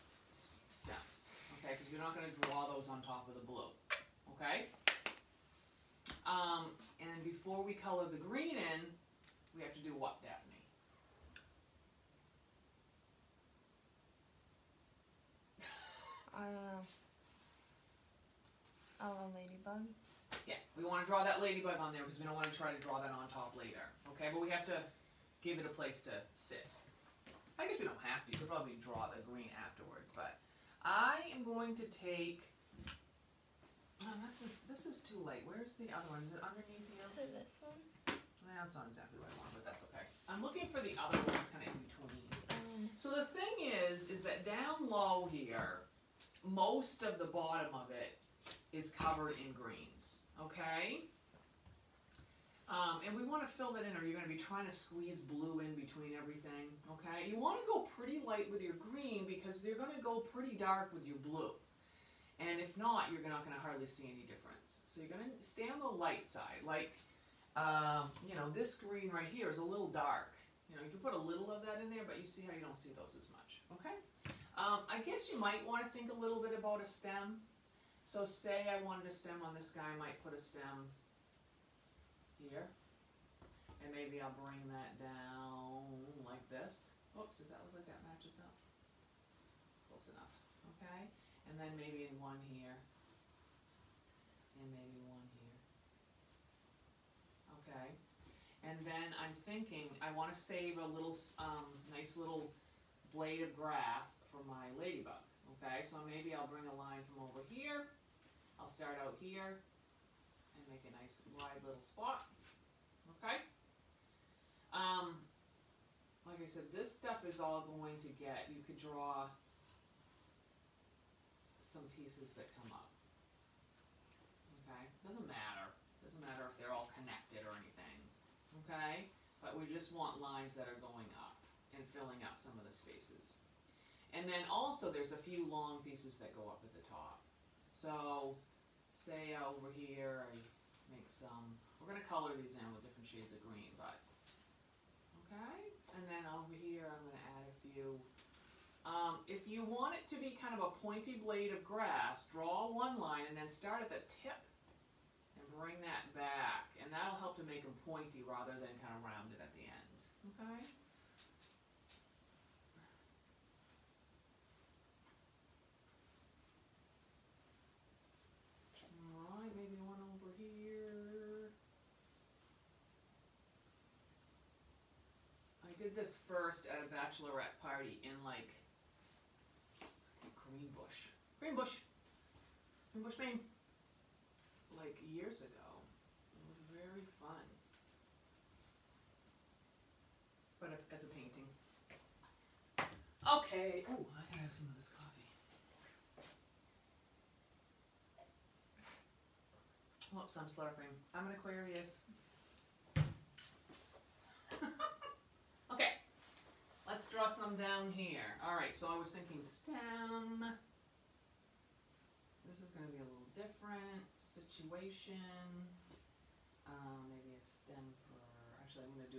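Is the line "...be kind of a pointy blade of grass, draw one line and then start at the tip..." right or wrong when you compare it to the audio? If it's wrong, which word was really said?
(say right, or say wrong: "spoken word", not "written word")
right.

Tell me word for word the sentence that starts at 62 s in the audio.
And if not, you're not going to hardly see any difference.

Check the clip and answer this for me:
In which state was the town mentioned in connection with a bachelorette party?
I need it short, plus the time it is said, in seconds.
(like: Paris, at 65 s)
Maine, at 183 s.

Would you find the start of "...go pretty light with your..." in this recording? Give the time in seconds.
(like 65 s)
57 s.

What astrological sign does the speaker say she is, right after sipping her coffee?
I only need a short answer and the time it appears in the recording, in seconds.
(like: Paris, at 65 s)
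Aquarius, at 201 s.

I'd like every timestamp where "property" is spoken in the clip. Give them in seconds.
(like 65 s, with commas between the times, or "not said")
not said.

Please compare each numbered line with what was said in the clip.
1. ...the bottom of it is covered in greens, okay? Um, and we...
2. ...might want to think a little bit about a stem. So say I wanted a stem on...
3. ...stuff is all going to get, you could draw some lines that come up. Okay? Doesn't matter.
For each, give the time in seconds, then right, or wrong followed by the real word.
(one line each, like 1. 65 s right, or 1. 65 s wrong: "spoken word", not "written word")
1. 47 s right
2. 75 s right
3. 116 s wrong: "pieces", not "lines".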